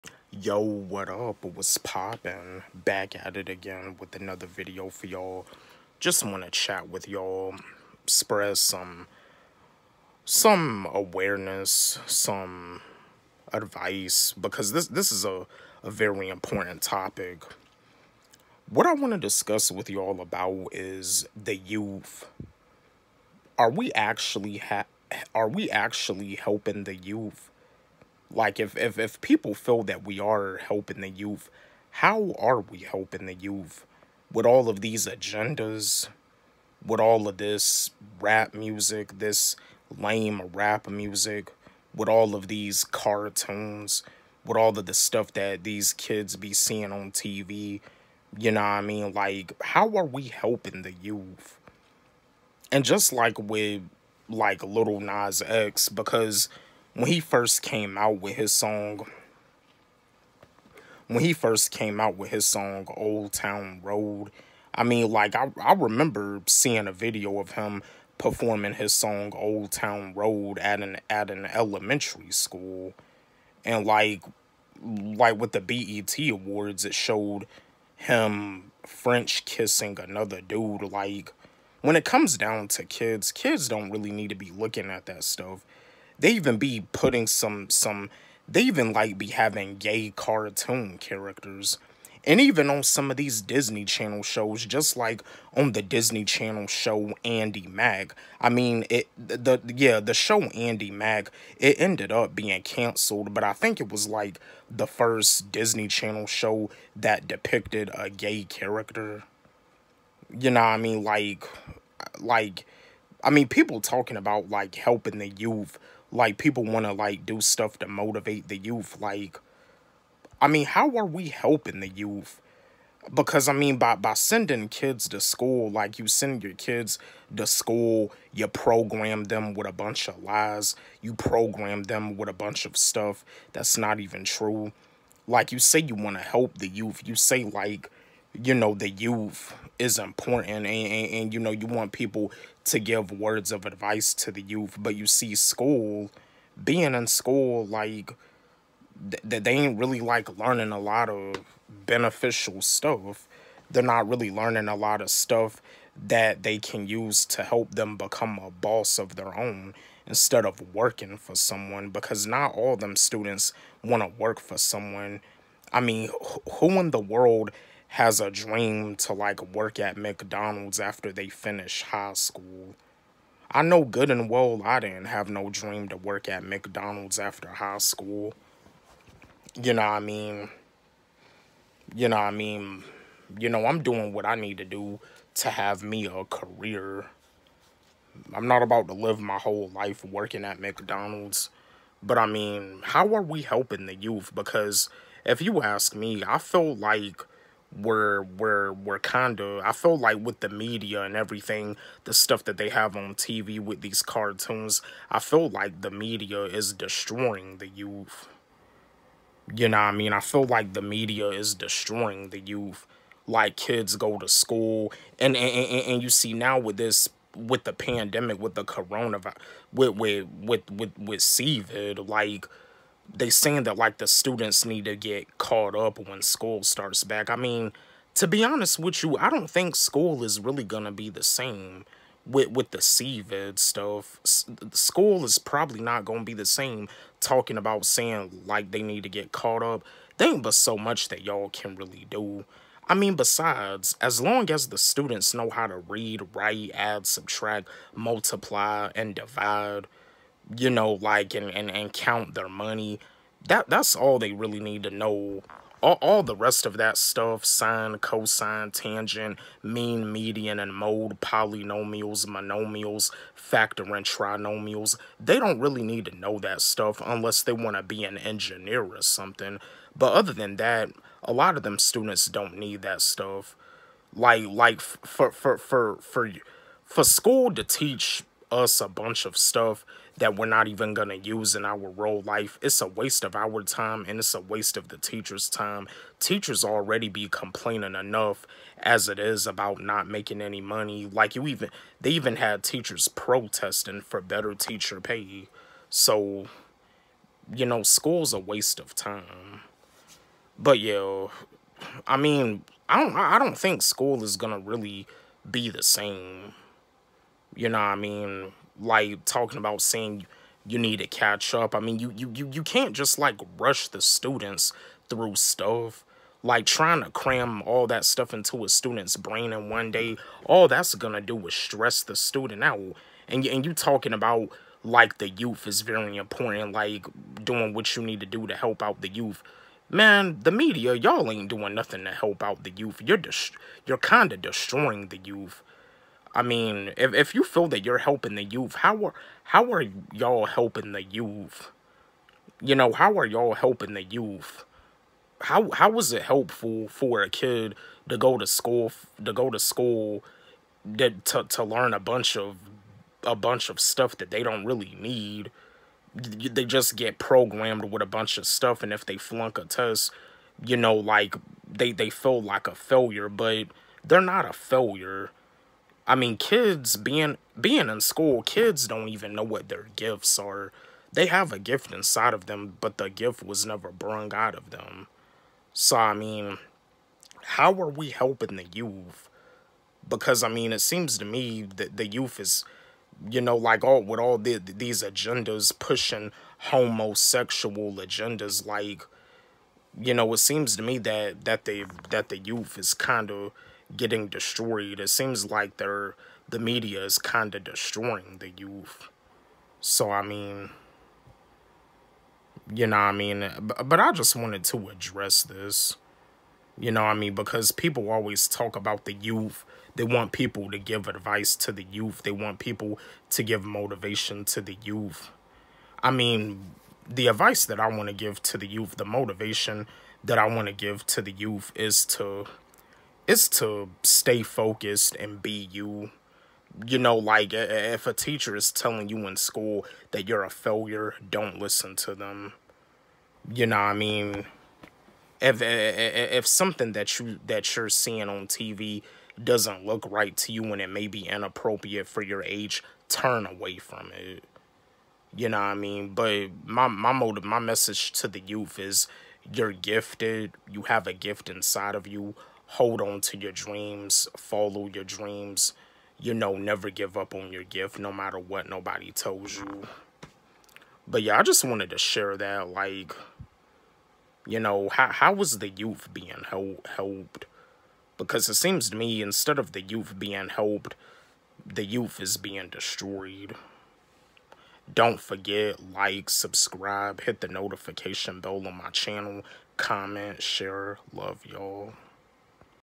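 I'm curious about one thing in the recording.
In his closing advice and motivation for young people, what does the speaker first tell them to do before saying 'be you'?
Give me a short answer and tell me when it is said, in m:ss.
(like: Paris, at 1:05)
stay focused, at 7:04.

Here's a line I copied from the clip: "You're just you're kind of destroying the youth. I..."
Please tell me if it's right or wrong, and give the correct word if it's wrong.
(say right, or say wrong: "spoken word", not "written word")
right.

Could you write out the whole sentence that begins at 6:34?
It seems like they're the media is kind of destroying the youth.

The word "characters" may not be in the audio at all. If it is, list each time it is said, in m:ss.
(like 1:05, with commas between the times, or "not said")
1:30, 1:48.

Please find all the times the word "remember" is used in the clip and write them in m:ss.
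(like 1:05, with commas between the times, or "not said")
1:05.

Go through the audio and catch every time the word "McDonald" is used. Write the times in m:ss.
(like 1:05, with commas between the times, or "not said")
2:49, 2:56, 3:10.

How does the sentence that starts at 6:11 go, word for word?
They have a gift inside of them, but the gift was never brung out of them.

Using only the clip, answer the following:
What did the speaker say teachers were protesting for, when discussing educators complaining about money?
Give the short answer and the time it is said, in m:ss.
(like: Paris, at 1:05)
better teacher pay, at 4:54.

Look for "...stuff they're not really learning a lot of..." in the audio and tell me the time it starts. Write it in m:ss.
2:32.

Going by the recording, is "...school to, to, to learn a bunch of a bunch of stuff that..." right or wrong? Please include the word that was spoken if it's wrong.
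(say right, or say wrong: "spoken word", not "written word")
right.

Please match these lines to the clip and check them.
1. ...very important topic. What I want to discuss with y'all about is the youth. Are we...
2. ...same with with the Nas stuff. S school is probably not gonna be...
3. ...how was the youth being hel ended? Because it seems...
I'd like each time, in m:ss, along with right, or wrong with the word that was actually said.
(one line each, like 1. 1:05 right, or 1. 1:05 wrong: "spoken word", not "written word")
1. 0:15 right
2. 3:51 wrong: "COVID", not "Nas"
3. 7:45 wrong: "helped", not "ended".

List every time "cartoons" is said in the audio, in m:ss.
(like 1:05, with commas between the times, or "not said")
0:42, 1:30, 3:24.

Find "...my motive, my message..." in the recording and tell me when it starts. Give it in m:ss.
7:26.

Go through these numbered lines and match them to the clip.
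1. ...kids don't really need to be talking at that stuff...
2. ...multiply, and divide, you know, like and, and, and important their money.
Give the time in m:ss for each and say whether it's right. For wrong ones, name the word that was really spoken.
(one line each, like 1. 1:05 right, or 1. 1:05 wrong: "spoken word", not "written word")
1. 1:23 wrong: "looking", not "talking"
2. 4:07 wrong: "count", not "important".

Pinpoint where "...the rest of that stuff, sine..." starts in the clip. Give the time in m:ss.
4:16.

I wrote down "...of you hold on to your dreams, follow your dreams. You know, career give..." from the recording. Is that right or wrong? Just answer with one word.
wrong.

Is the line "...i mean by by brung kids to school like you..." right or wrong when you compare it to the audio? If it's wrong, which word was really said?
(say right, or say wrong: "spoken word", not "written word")
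wrong: "sending", not "brung".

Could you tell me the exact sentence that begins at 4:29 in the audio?
But other than that, a lot of them students don't need that stuff.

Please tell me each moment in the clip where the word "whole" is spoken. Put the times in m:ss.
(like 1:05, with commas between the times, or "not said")
3:09.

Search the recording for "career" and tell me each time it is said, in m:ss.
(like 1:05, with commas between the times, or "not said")
3:06.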